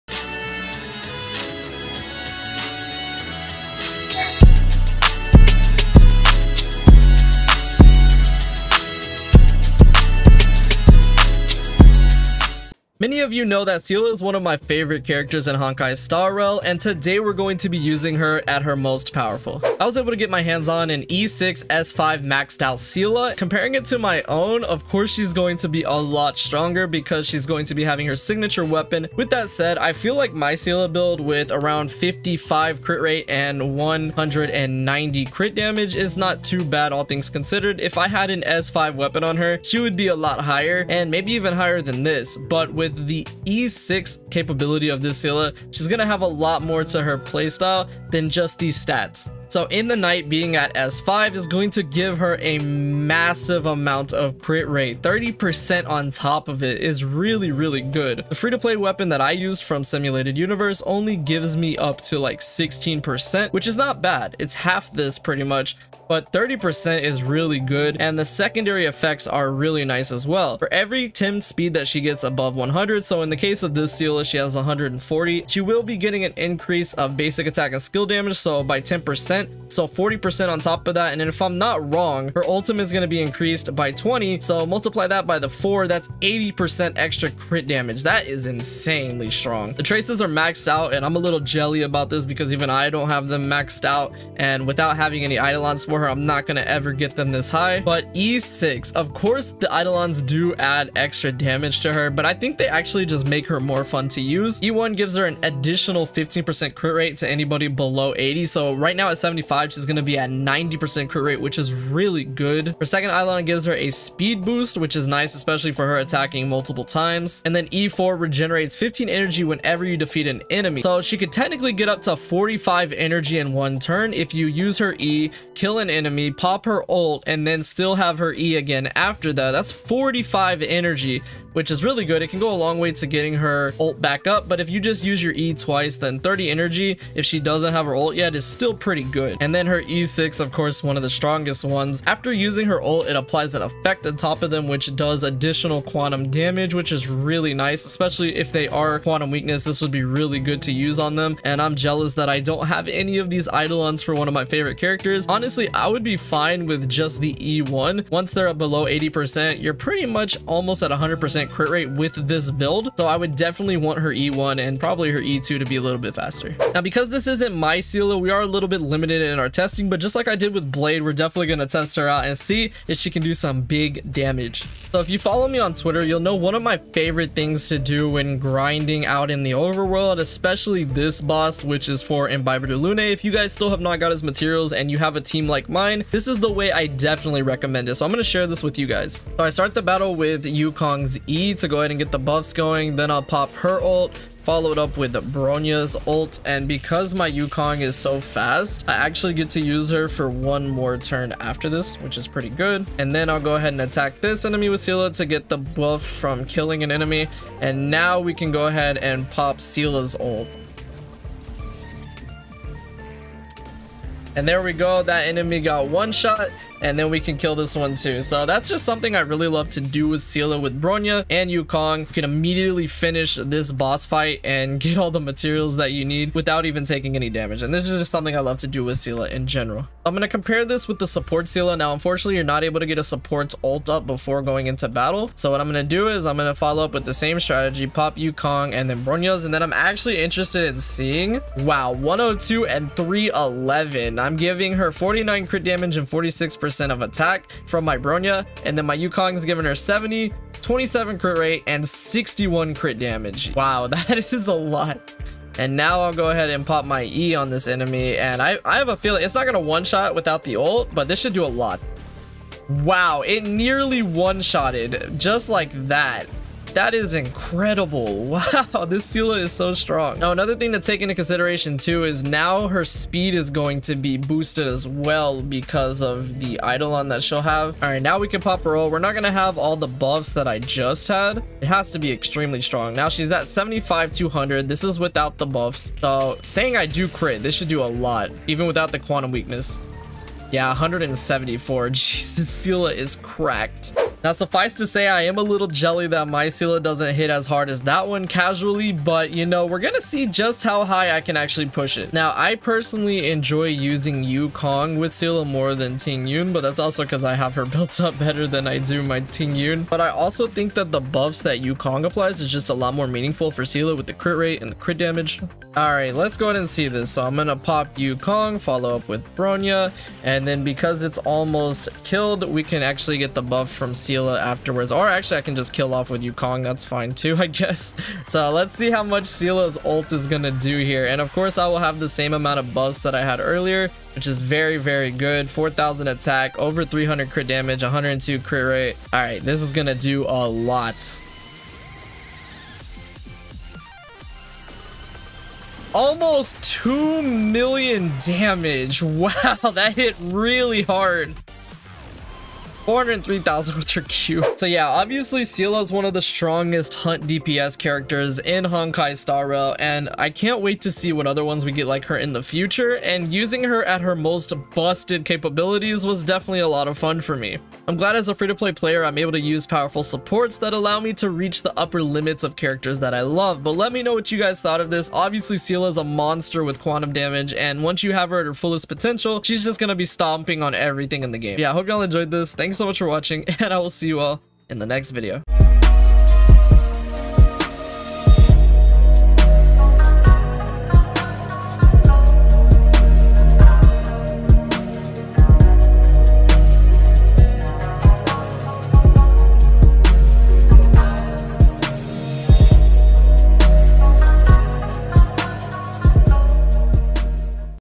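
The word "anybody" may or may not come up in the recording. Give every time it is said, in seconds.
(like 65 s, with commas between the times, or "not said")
107 s.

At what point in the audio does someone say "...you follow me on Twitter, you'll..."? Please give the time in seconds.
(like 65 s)
175 s.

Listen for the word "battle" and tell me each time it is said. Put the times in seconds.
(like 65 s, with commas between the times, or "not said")
189 s, 234 s.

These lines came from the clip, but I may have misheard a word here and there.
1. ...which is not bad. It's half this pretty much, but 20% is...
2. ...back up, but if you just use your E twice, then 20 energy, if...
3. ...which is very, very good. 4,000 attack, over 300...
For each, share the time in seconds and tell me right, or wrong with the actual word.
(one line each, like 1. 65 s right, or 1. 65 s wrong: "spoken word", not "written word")
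1. 63 s wrong: "30", not "20"
2. 134 s wrong: "30", not "20"
3. 334 s right.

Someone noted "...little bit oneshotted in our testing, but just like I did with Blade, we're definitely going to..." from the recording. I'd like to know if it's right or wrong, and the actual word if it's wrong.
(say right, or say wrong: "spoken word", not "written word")
wrong: "limited", not "oneshotted".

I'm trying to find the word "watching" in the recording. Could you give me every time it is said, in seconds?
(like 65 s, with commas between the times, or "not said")
383 s.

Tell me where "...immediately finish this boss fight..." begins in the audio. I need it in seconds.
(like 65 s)
222 s.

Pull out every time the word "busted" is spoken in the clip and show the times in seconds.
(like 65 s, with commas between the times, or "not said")
364 s.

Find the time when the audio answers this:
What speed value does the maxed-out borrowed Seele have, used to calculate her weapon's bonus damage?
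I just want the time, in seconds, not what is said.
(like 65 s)
74 s.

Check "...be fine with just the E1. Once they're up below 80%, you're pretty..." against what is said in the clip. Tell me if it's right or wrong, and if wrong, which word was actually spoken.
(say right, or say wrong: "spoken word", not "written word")
right.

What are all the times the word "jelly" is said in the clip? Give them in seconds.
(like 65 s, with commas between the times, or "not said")
91 s, 295 s.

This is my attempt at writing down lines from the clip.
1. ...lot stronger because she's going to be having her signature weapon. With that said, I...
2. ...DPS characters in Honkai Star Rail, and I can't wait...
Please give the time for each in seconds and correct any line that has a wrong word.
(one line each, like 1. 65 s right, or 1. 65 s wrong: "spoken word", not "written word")
1. 25 s right
2. 357 s right.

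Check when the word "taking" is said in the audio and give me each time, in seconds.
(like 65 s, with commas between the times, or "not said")
226 s.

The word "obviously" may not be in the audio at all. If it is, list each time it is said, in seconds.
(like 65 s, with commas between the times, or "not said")
354 s, 375 s.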